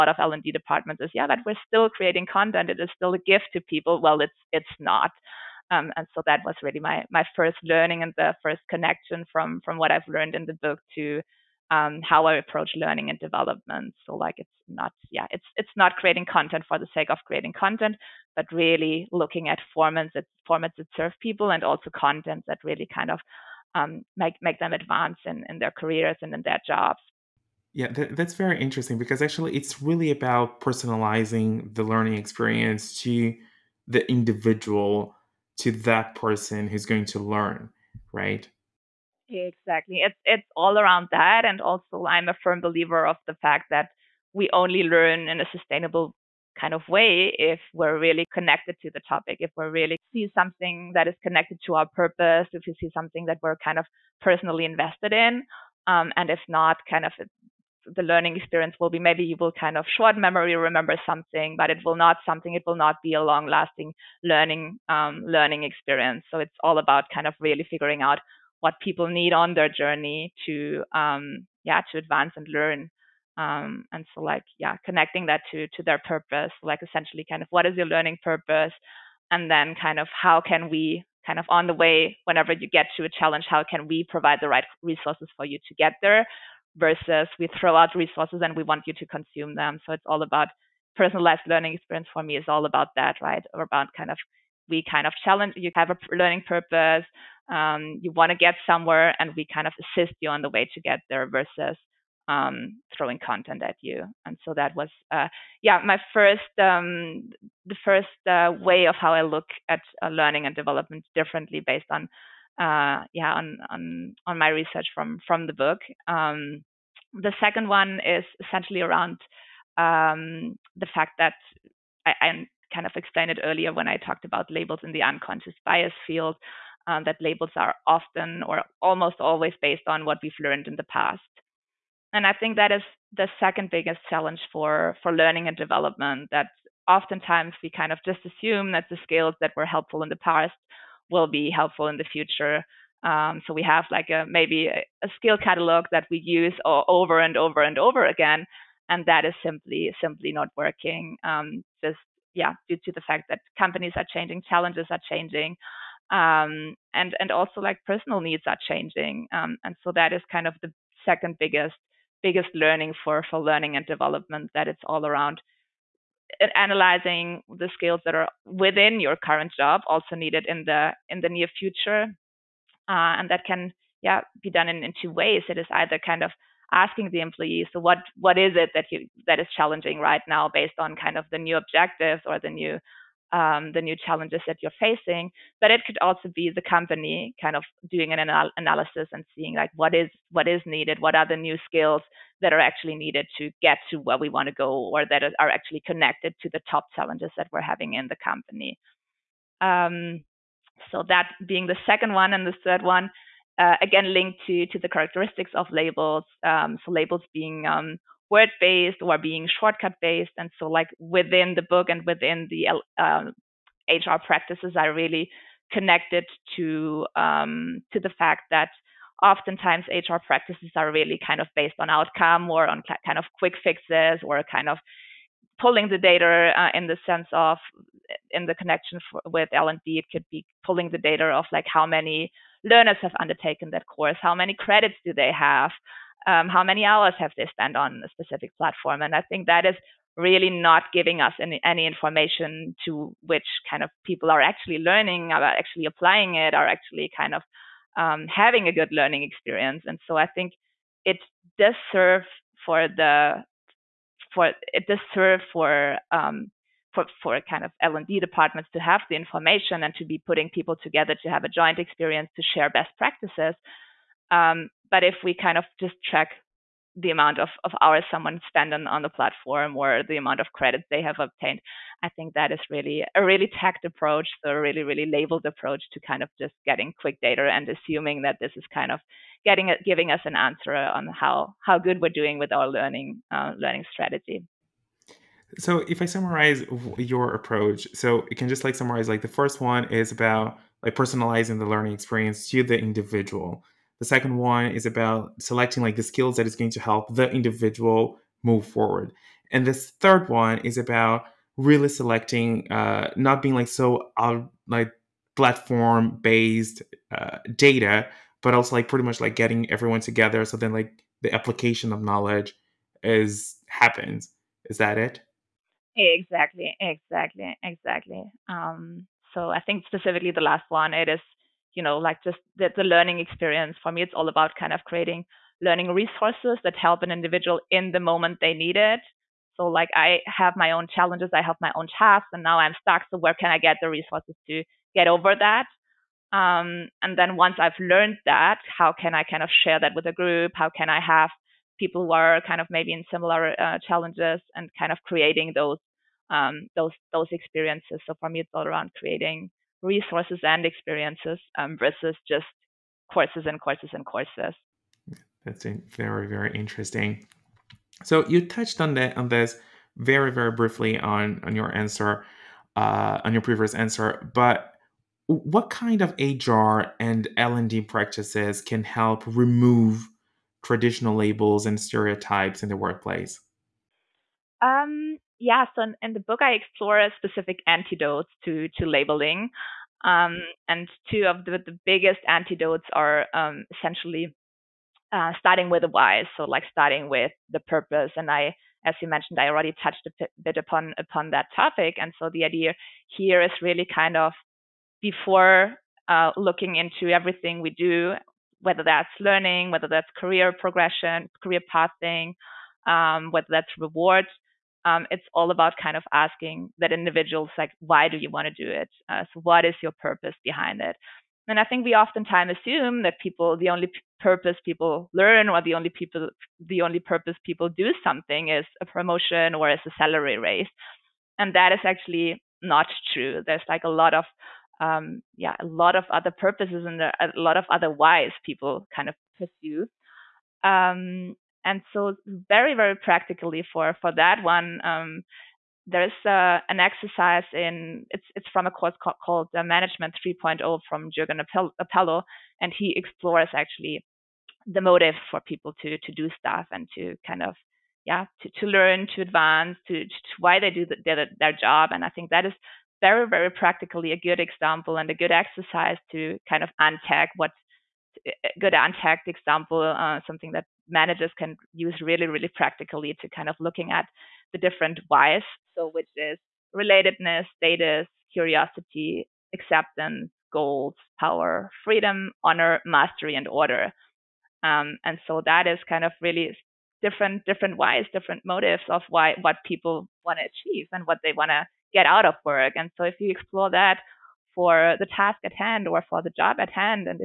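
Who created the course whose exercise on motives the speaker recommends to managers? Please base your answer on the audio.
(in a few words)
Jürgen Appelo.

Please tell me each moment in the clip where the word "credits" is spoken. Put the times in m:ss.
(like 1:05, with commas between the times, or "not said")
3:54, 4:30.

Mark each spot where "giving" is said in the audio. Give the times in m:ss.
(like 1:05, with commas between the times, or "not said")
4:00, 4:39.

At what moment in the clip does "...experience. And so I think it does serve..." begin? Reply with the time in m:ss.
4:09.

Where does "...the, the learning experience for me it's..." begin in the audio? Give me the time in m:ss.
5:22.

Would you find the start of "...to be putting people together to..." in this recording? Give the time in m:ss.
4:19.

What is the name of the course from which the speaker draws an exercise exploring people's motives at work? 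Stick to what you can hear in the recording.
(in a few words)
Management 3.0.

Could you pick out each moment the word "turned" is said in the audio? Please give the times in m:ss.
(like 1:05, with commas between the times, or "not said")
not said.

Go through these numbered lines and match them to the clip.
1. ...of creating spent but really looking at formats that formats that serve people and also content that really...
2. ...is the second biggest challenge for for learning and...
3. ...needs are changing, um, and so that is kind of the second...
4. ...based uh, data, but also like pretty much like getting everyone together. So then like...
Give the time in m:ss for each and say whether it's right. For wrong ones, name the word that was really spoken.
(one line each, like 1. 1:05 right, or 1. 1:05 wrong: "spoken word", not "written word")
1. 0:17 wrong: "content", not "spent"
2. 2:12 right
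3. 2:38 right
4. 5:06 right.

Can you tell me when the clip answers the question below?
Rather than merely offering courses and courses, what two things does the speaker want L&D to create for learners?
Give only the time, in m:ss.
5:49.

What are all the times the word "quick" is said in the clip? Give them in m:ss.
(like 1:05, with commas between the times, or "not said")
3:43, 4:36.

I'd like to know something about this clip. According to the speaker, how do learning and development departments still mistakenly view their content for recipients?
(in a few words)
A gift.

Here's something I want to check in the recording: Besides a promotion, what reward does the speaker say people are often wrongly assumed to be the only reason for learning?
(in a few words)
A salary raise.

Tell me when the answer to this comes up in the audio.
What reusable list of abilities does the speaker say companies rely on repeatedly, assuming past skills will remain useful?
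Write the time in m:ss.
2:25.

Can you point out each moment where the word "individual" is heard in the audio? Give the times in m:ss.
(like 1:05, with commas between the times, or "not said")
0:34, 4:52, 4:57, 5:27, 6:46.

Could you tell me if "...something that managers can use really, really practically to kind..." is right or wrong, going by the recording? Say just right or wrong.
right.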